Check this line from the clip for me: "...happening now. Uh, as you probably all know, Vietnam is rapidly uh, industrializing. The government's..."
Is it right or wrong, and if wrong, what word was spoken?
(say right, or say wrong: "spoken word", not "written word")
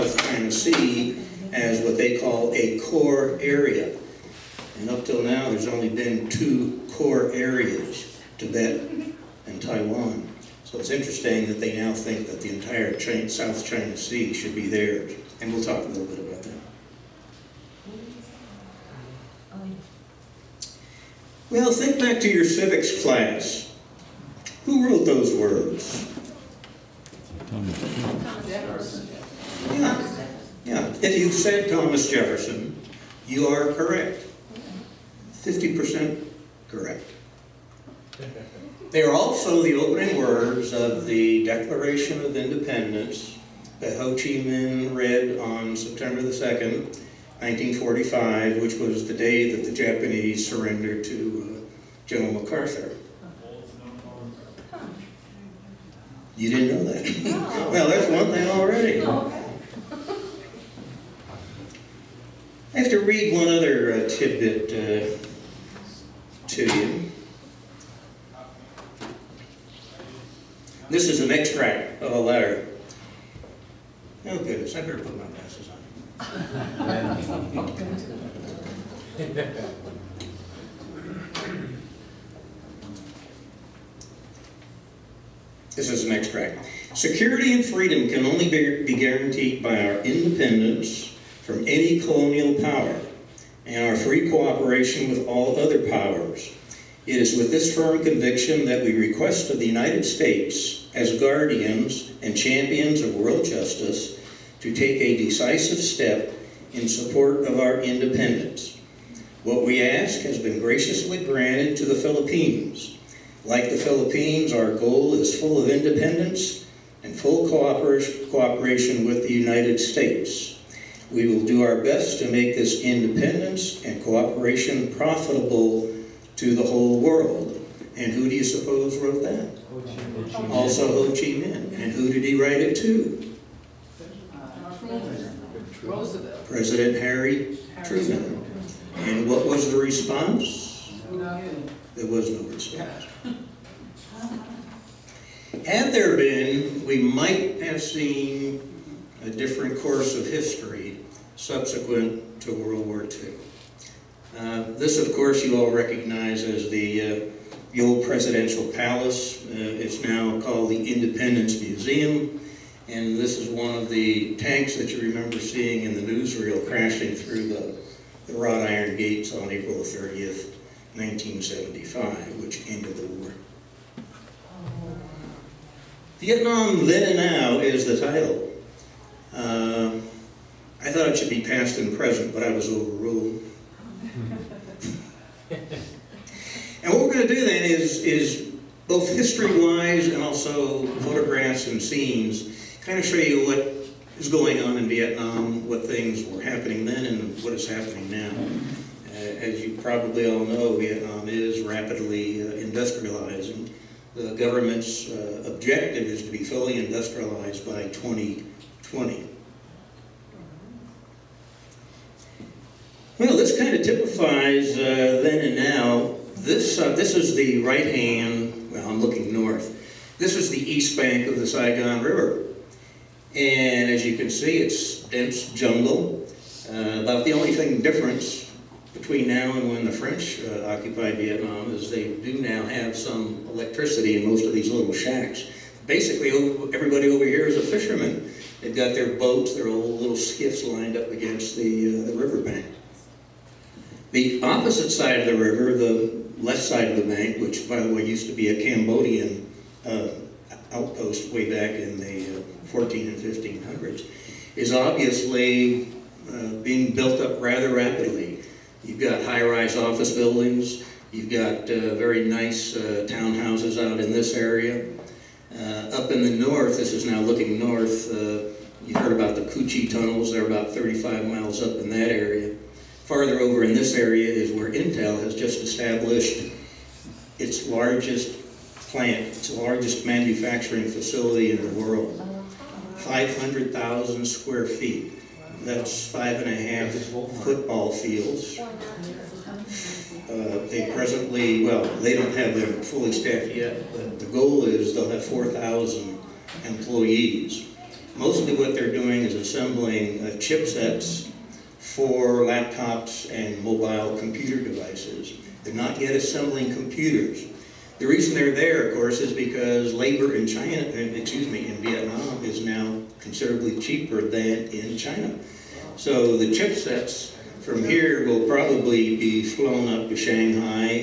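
right.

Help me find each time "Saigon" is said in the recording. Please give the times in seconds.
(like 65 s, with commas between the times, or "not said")
221 s.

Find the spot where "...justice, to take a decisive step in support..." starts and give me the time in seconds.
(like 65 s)
103 s.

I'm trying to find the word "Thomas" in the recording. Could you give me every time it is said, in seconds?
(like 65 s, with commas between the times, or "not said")
27 s, 31 s.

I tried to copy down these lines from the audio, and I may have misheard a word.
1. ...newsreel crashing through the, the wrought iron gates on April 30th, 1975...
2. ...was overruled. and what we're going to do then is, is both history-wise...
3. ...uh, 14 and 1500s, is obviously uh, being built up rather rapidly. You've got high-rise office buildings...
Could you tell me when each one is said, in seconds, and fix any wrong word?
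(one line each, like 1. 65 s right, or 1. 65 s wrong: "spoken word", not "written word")
1. 166 s right
2. 182 s right
3. 252 s right.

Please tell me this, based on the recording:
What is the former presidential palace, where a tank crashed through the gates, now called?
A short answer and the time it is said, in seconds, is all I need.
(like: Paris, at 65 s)
Independence Museum, at 160 s.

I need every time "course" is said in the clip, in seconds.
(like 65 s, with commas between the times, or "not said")
149 s, 155 s, 308 s.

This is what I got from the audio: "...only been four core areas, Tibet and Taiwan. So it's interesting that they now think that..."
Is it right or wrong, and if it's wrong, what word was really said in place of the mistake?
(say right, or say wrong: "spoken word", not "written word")
wrong: "two", not "four".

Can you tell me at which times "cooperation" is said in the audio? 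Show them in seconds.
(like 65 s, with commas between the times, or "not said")
94 s, 117 s, 124 s.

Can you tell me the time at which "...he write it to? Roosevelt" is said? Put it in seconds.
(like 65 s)
132 s.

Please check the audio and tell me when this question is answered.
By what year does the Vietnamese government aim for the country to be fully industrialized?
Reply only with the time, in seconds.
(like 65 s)
207 s.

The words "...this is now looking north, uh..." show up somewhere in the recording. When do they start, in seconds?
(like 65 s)
266 s.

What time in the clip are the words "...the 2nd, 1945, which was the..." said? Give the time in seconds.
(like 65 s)
46 s.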